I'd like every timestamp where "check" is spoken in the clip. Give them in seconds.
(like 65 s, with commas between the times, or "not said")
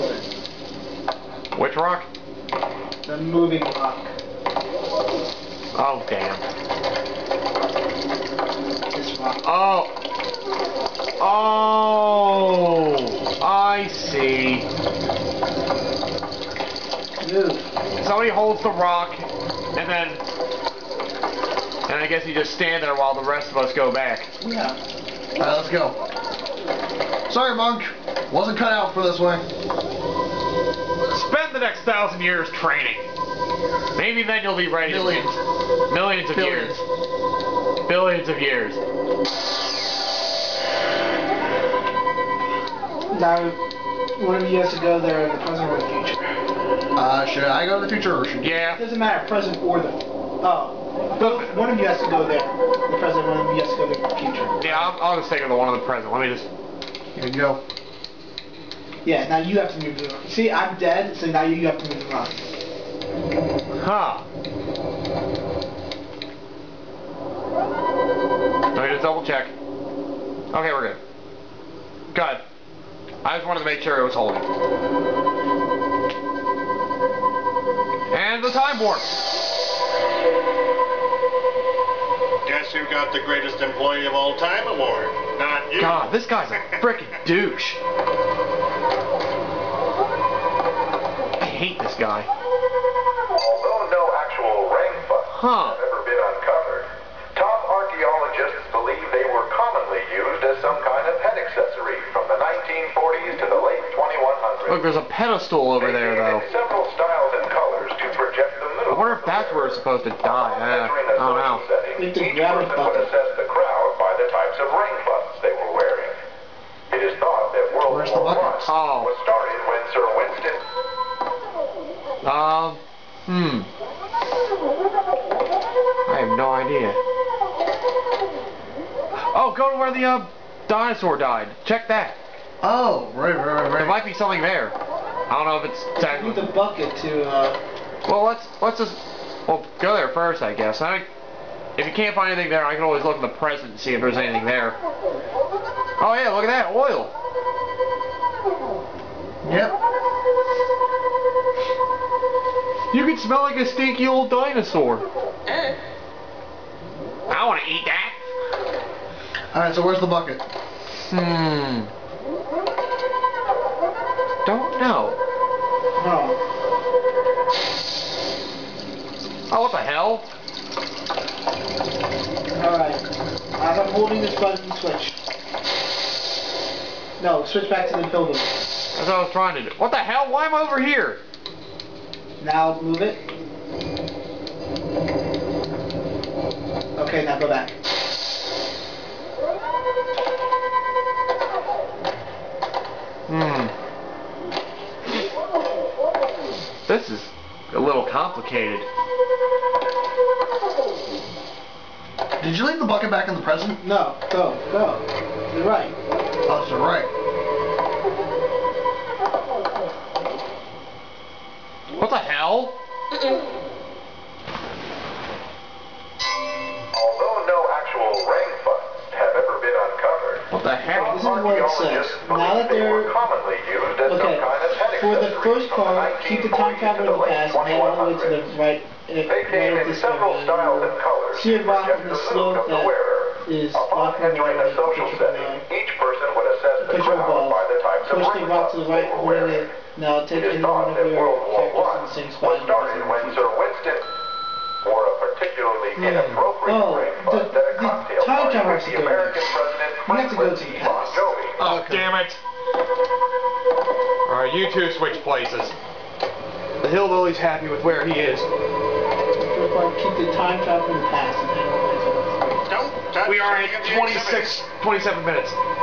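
69 s, 131 s.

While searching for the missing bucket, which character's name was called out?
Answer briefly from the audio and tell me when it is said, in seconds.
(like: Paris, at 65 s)
Winston, at 120 s.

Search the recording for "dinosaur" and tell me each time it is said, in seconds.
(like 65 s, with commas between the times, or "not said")
130 s, 154 s.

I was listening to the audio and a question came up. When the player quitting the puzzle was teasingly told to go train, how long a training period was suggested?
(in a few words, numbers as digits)
1000 years.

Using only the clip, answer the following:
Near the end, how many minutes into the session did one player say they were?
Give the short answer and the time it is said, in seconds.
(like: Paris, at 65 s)
27, at 264 s.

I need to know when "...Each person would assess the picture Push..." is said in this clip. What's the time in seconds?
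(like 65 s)
235 s.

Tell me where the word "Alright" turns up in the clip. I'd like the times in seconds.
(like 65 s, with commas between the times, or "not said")
24 s, 172 s, 254 s.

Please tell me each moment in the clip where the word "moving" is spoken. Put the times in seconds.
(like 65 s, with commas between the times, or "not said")
3 s.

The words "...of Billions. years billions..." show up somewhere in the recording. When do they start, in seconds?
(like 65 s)
36 s.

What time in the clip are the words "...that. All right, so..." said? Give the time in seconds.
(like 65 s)
157 s.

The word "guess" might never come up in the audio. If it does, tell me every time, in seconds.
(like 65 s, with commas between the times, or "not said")
22 s, 82 s, 140 s.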